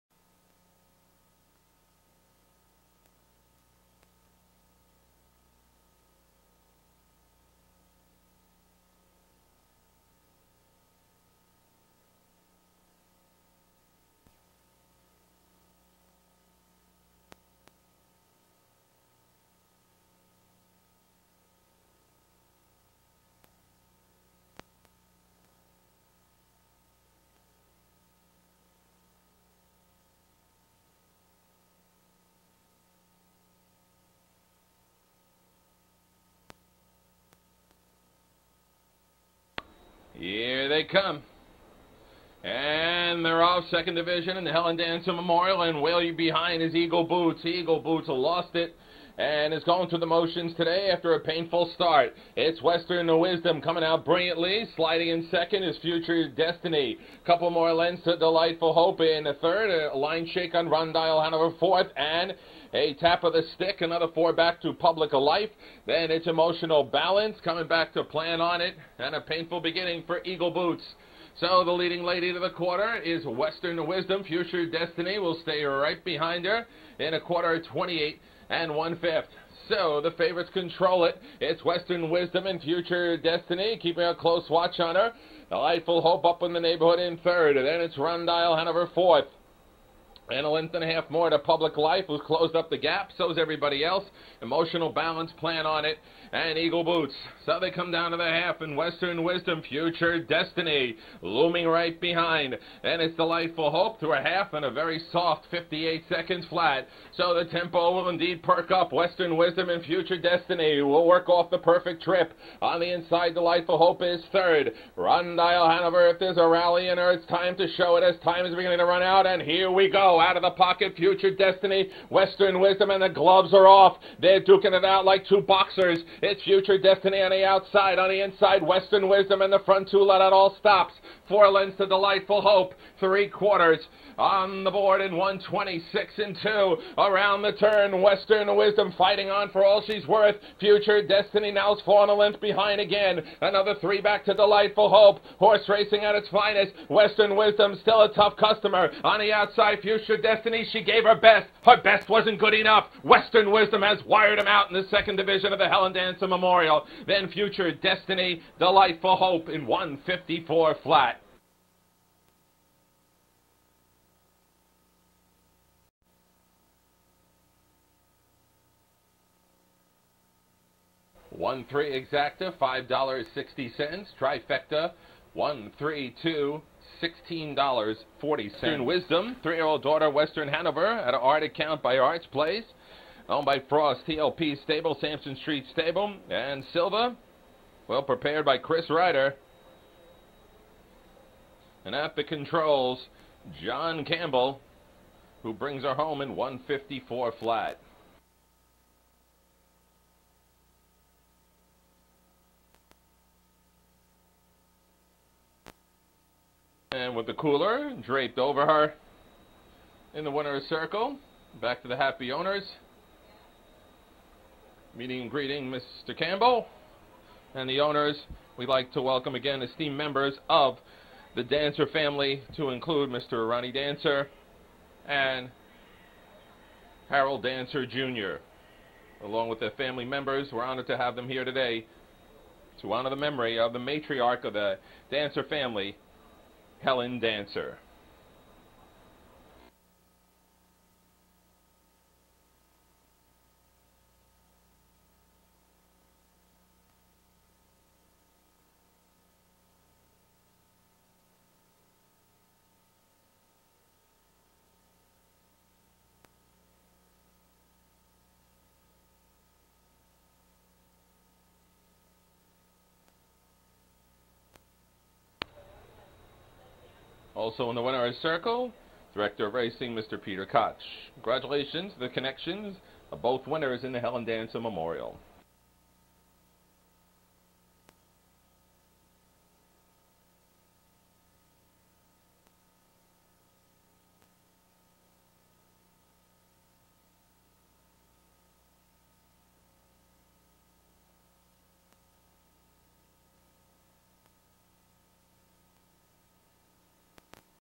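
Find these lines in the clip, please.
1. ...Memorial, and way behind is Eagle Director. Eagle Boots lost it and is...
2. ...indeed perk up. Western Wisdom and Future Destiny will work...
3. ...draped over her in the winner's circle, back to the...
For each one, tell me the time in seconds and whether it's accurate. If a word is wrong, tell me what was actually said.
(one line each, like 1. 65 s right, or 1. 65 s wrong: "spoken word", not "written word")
1. 45 s wrong: "Boots", not "Director"
2. 108 s right
3. 208 s right.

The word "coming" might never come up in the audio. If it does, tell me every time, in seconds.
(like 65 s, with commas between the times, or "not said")
53 s, 67 s.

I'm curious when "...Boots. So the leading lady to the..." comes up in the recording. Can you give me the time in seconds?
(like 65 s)
70 s.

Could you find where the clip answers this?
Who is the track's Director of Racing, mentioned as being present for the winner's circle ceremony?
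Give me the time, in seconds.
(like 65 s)
270 s.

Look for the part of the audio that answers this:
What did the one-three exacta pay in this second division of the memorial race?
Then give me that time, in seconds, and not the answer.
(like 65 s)
172 s.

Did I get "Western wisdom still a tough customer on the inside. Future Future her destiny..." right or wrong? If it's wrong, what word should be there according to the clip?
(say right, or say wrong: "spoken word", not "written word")
wrong: "outside", not "inside".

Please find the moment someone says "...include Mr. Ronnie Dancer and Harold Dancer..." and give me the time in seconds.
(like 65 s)
222 s.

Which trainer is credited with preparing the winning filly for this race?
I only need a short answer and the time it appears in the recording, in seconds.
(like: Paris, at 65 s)
Chris Ryder, at 188 s.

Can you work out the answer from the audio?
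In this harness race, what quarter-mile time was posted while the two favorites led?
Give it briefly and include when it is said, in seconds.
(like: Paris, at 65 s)
28 1/5, at 77 s.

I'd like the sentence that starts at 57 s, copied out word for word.
Couple more lengths to Delightful Hope in the third.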